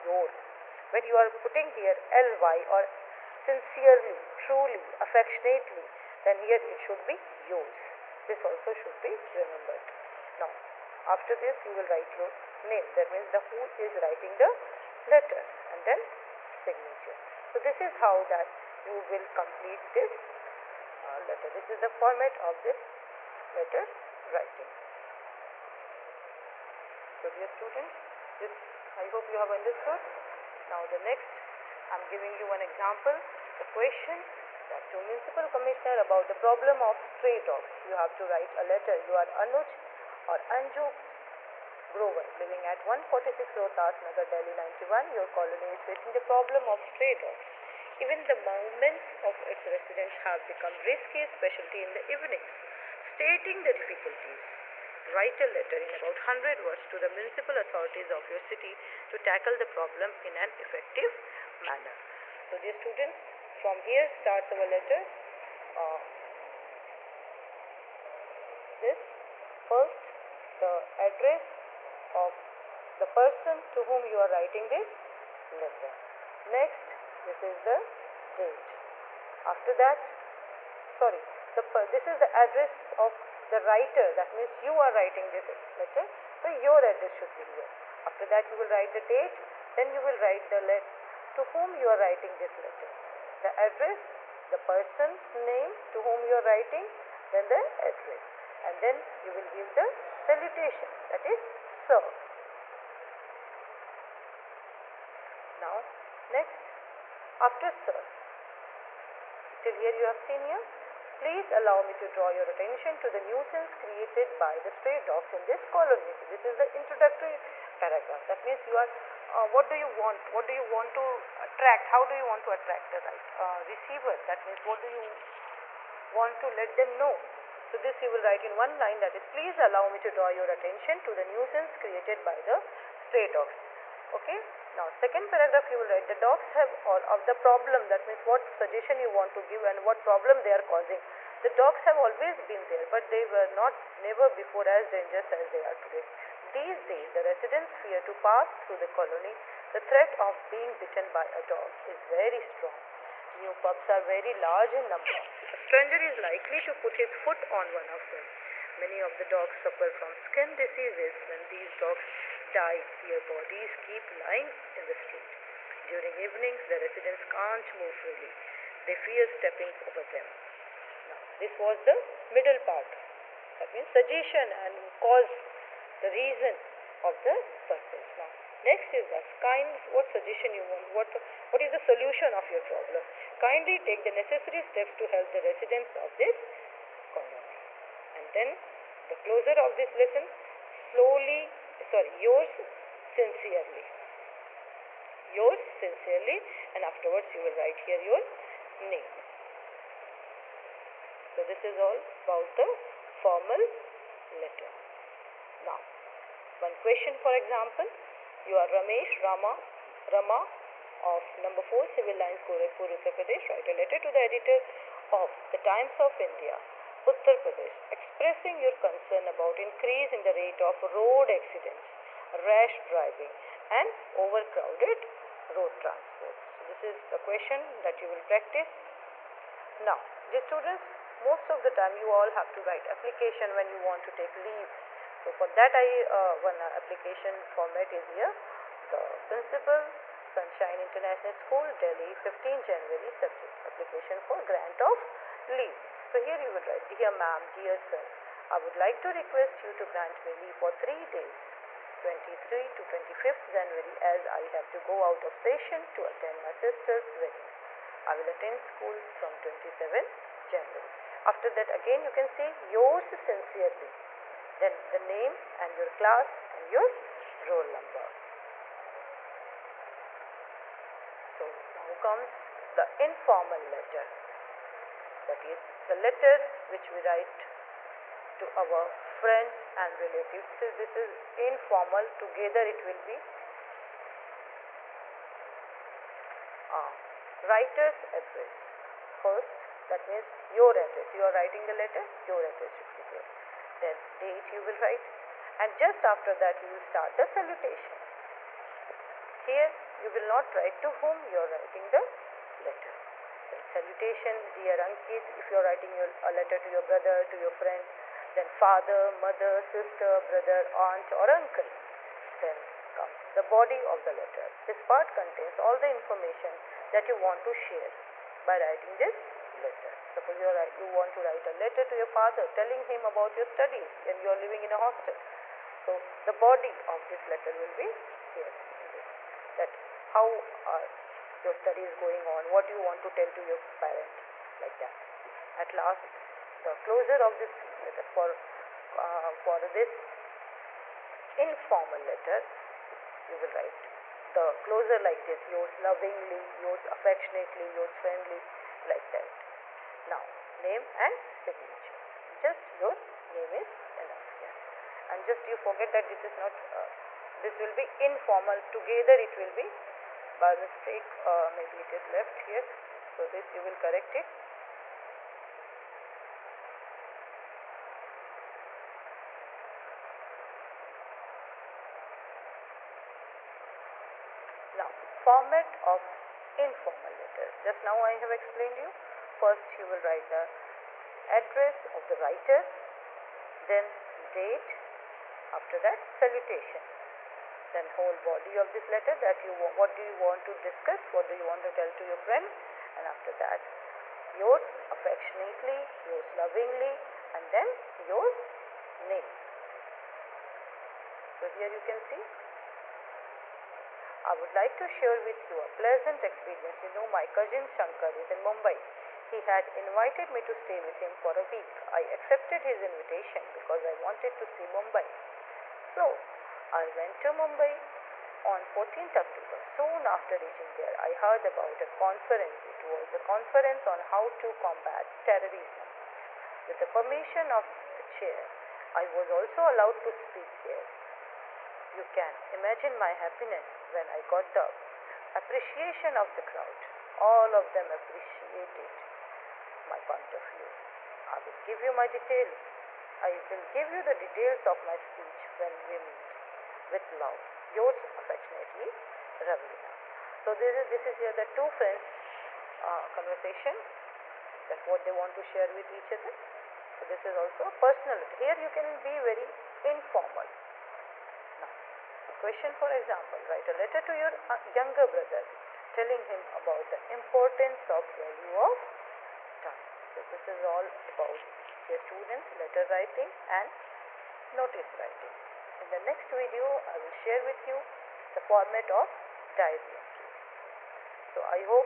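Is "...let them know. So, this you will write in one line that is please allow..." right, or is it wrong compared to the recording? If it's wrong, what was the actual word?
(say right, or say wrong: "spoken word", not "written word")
right.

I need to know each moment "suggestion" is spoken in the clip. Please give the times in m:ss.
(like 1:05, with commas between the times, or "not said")
2:18, 2:53, 3:00.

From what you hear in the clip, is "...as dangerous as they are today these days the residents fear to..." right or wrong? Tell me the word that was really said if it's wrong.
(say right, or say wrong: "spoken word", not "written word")
right.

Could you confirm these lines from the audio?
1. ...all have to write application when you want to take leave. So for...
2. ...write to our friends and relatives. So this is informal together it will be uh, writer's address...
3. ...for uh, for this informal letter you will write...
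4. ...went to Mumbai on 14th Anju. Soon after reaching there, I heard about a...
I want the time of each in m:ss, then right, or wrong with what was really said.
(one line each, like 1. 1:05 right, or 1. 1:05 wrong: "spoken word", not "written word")
1. 3:52 right
2. 4:37 right
3. 5:38 right
4. 6:56 wrong: "October", not "Anju".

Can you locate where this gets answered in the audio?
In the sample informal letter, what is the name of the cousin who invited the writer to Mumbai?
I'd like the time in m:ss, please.
6:47.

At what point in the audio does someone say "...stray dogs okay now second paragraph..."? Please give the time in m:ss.
2:12.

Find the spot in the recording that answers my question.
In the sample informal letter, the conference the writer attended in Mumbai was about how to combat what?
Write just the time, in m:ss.
7:05.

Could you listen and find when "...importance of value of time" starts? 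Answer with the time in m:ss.
7:47.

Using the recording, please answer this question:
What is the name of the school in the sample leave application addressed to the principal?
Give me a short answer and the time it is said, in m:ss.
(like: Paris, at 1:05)
Sunshine International School, at 4:00.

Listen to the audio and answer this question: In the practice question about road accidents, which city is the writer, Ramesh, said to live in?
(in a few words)
Gorakhpur.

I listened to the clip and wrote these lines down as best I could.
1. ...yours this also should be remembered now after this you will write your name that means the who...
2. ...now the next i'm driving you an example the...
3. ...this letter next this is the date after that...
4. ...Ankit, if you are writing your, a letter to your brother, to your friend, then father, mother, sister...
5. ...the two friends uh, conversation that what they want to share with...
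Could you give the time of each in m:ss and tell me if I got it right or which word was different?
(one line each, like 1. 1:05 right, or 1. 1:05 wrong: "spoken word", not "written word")
1. 0:07 right
2. 0:30 wrong: "giving", not "driving"
3. 1:14 right
4. 5:04 right
5. 7:31 right.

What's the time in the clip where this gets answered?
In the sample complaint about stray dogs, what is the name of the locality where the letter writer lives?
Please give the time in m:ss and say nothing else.
0:43.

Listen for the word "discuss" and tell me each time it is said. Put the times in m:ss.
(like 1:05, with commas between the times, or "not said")
6:30.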